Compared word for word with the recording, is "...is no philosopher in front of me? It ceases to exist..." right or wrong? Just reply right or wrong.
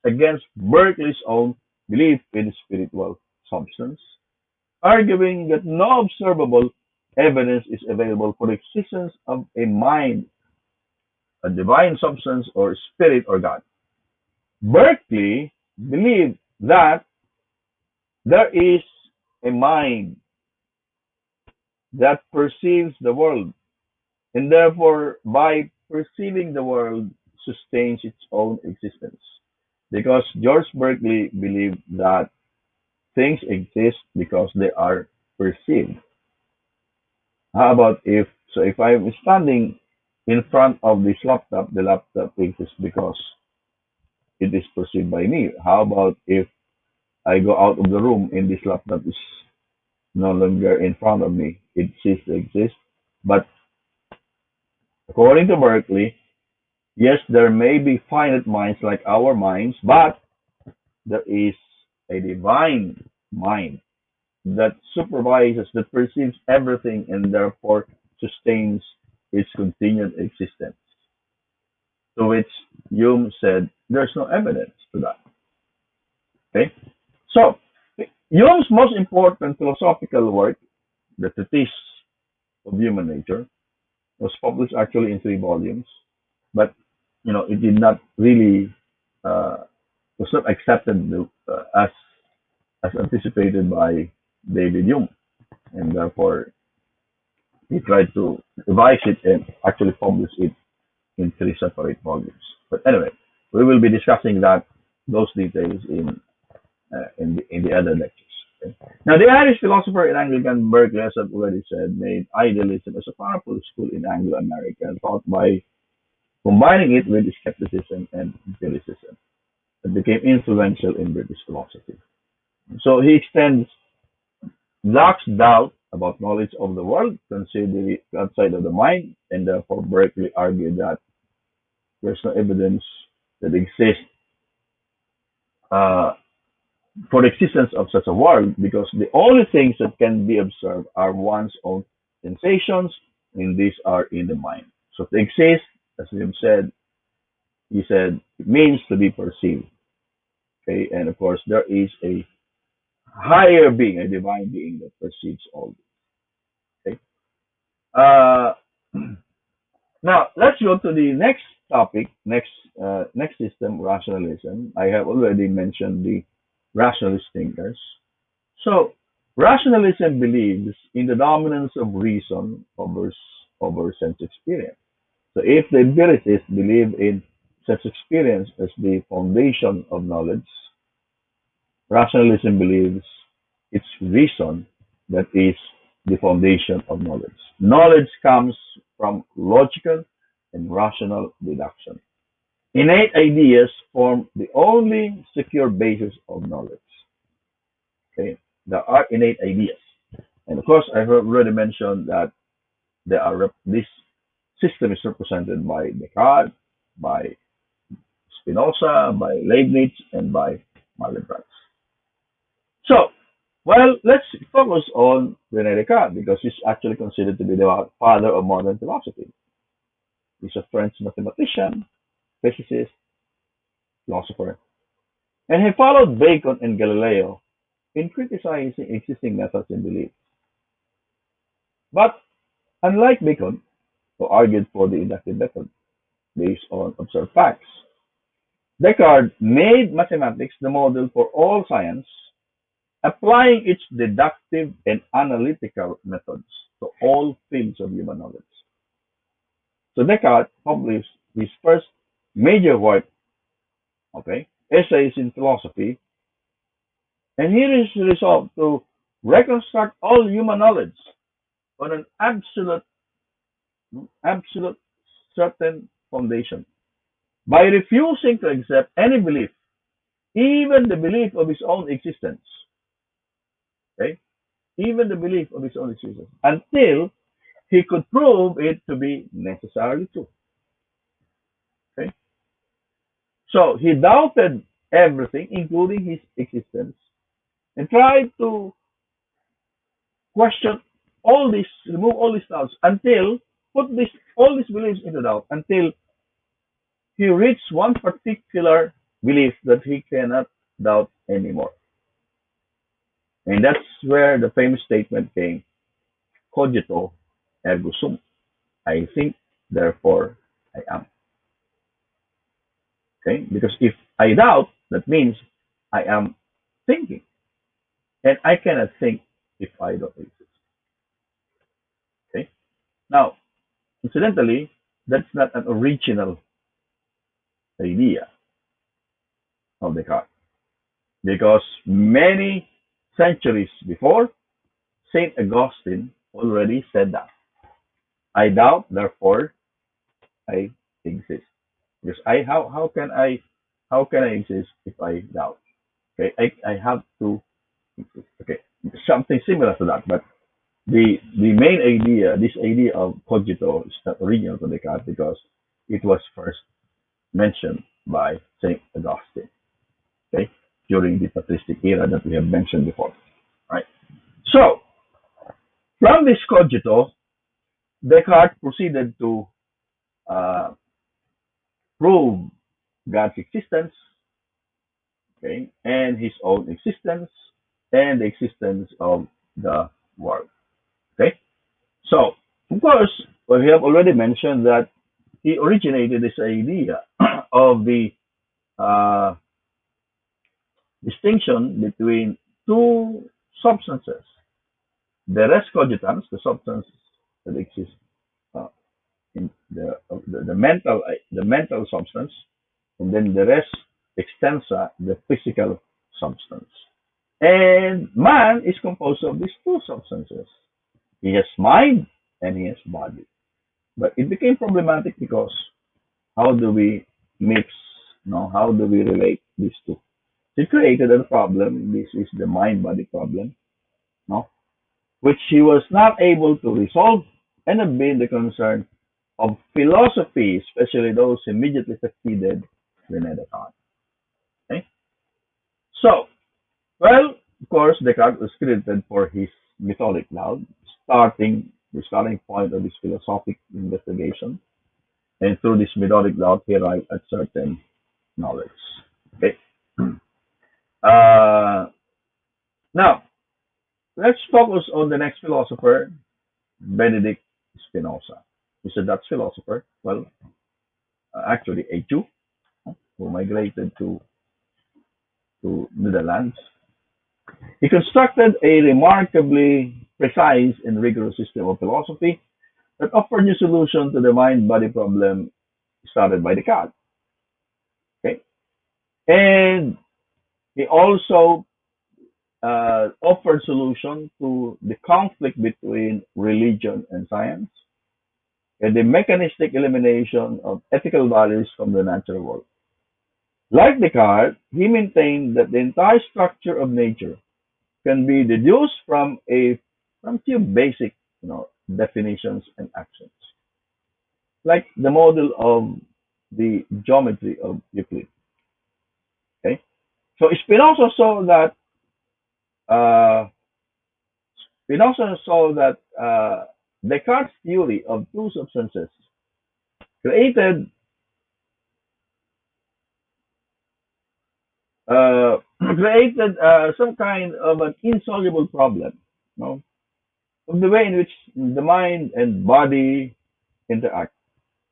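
wrong.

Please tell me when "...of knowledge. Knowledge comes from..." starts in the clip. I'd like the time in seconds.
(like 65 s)
186 s.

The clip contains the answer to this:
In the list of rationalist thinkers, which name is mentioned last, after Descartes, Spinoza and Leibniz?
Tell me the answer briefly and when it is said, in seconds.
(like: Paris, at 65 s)
Malebranche, at 210 s.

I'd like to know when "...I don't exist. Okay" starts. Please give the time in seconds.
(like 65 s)
319 s.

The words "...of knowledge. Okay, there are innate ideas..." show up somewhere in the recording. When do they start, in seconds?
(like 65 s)
196 s.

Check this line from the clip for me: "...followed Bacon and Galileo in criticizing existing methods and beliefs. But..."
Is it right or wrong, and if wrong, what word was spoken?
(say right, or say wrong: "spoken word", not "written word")
right.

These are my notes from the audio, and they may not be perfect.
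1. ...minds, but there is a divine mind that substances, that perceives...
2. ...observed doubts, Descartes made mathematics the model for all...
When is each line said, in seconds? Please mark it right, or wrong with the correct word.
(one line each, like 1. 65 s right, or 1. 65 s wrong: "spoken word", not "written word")
1. 59 s wrong: "supervises", not "substances"
2. 236 s wrong: "facts", not "doubts".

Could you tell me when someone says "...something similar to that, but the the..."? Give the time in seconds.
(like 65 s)
349 s.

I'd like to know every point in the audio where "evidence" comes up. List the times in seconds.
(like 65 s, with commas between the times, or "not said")
7 s, 74 s, 132 s.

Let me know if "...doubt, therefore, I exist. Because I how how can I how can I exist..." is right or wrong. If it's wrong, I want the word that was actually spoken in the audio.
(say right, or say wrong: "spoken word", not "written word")
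right.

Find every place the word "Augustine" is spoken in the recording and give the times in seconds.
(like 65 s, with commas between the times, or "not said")
335 s, 358 s.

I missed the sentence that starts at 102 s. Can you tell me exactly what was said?
But anyway, we will be discussing that those details in uh, in the in the other lectures.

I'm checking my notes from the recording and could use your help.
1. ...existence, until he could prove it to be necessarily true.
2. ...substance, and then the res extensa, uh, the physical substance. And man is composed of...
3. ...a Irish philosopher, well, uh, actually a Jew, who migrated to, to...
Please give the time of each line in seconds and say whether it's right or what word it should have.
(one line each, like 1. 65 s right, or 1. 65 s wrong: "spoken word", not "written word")
1. 275 s right
2. 401 s right
3. 458 s wrong: "Dutch", not "Irish".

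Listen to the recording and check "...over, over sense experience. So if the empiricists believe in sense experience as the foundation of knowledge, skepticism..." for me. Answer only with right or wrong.
wrong.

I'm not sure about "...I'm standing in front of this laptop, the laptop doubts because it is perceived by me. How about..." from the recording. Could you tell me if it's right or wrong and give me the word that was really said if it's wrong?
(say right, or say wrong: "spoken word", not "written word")
wrong: "exists", not "doubts".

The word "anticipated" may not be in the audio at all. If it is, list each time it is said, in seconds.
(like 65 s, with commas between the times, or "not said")
93 s.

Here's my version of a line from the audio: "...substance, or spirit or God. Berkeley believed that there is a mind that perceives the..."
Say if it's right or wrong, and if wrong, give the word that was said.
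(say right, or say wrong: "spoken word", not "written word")
right.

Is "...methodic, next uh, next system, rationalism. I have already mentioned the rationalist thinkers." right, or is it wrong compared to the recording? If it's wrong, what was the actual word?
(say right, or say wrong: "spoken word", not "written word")
wrong: "topic", not "methodic".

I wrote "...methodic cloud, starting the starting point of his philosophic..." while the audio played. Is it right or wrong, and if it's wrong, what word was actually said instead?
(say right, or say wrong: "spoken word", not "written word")
right.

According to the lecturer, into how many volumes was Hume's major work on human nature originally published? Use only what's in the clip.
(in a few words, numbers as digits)
3.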